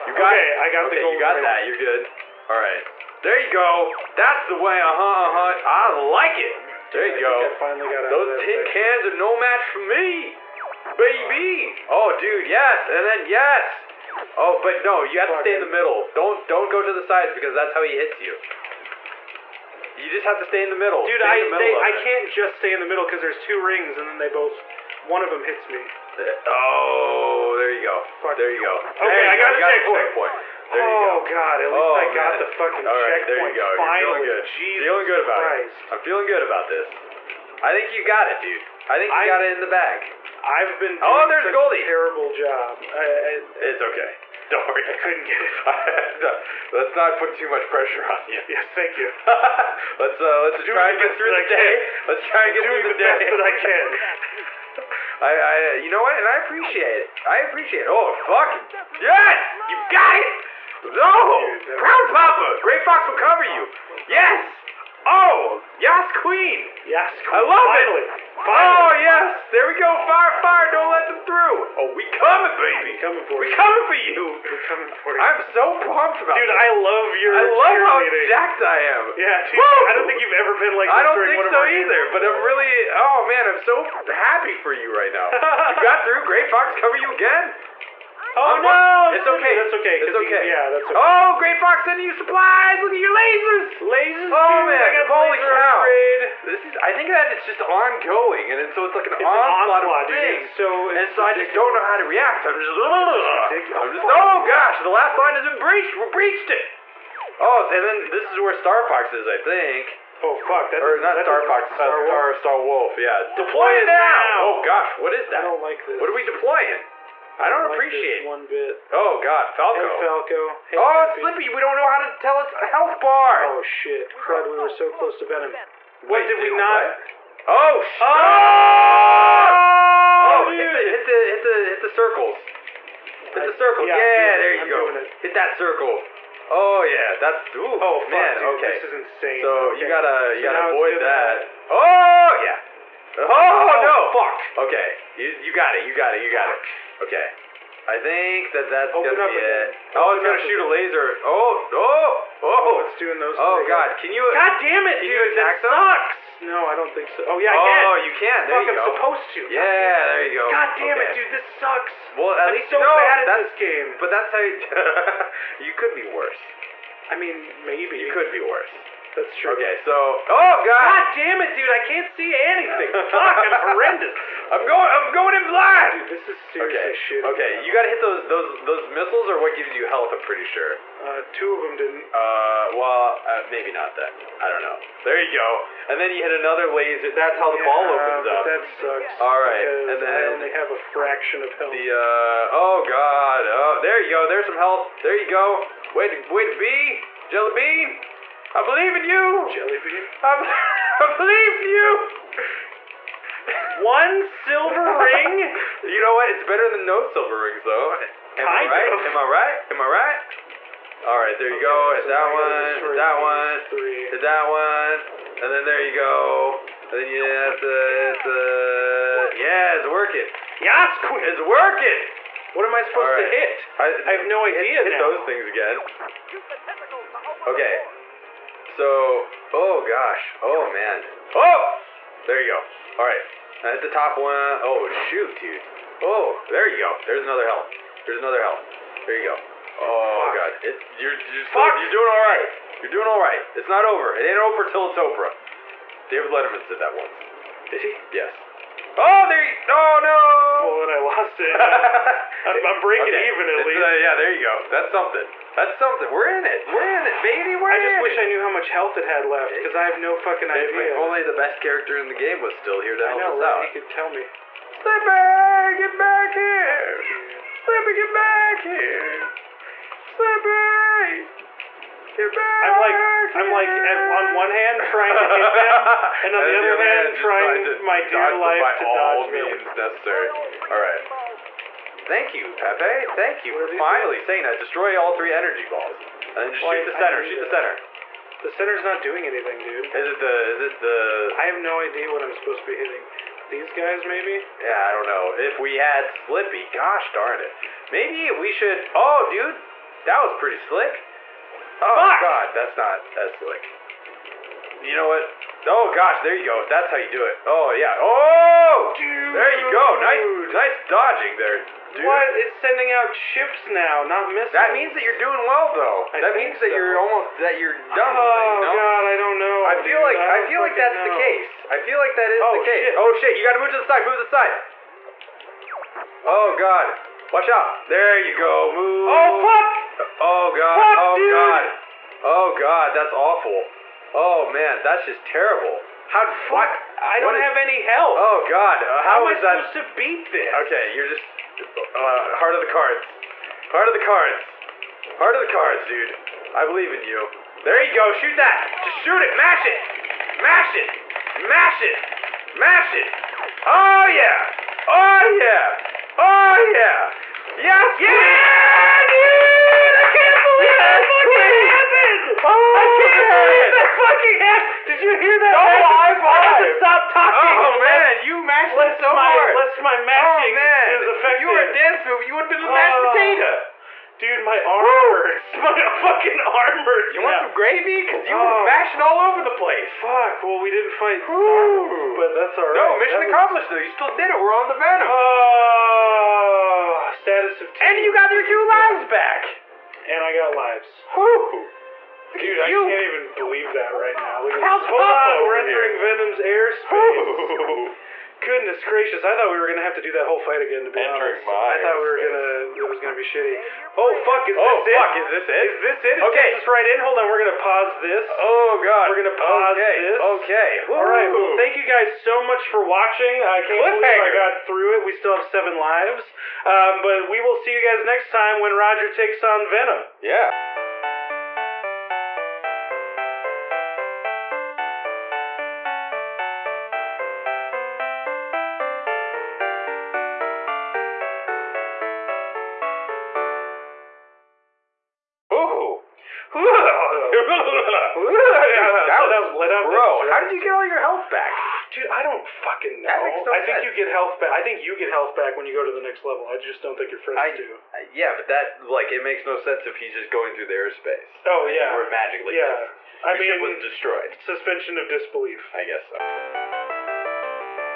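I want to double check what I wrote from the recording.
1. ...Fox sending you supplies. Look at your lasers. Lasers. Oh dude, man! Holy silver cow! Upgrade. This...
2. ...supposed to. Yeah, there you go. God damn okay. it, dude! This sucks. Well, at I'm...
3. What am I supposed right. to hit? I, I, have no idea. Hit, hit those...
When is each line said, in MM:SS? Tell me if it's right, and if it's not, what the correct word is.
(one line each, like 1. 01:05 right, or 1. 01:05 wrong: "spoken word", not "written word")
1. 01:31 wrong: "laser", not "silver"
2. 02:38 right
3. 03:42 right.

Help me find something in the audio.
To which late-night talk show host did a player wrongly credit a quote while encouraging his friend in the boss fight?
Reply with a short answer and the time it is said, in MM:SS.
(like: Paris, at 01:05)
David Letterman, at 04:06.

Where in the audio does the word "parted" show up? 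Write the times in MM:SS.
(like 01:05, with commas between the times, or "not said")
not said.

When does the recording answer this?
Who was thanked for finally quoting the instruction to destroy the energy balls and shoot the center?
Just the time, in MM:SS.
04:42.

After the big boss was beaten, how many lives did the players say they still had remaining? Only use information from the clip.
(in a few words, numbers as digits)
7.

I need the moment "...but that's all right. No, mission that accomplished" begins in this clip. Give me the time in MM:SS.
06:21.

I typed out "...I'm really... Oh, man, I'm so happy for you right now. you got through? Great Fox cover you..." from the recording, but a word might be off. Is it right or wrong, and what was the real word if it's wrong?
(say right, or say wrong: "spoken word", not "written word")
right.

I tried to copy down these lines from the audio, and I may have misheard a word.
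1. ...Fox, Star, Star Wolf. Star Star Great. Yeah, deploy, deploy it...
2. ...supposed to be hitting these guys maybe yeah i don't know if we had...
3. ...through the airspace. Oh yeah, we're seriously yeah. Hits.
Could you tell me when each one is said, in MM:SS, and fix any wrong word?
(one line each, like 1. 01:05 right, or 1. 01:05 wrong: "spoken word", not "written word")
1. 01:51 wrong: "Wolf", not "Great"
2. 04:52 right
3. 07:30 wrong: "magically", not "seriously".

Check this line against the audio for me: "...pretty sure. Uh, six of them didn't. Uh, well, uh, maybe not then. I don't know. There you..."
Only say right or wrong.
wrong.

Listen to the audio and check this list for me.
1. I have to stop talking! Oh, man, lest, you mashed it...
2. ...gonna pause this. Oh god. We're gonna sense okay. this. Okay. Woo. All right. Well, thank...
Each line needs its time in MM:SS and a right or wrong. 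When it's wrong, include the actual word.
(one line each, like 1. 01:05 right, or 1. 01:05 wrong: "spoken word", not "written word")
1. 06:06 right
2. 06:47 wrong: "pause", not "sense".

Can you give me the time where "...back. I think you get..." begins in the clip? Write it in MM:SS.
07:24.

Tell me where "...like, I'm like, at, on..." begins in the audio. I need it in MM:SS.
04:32.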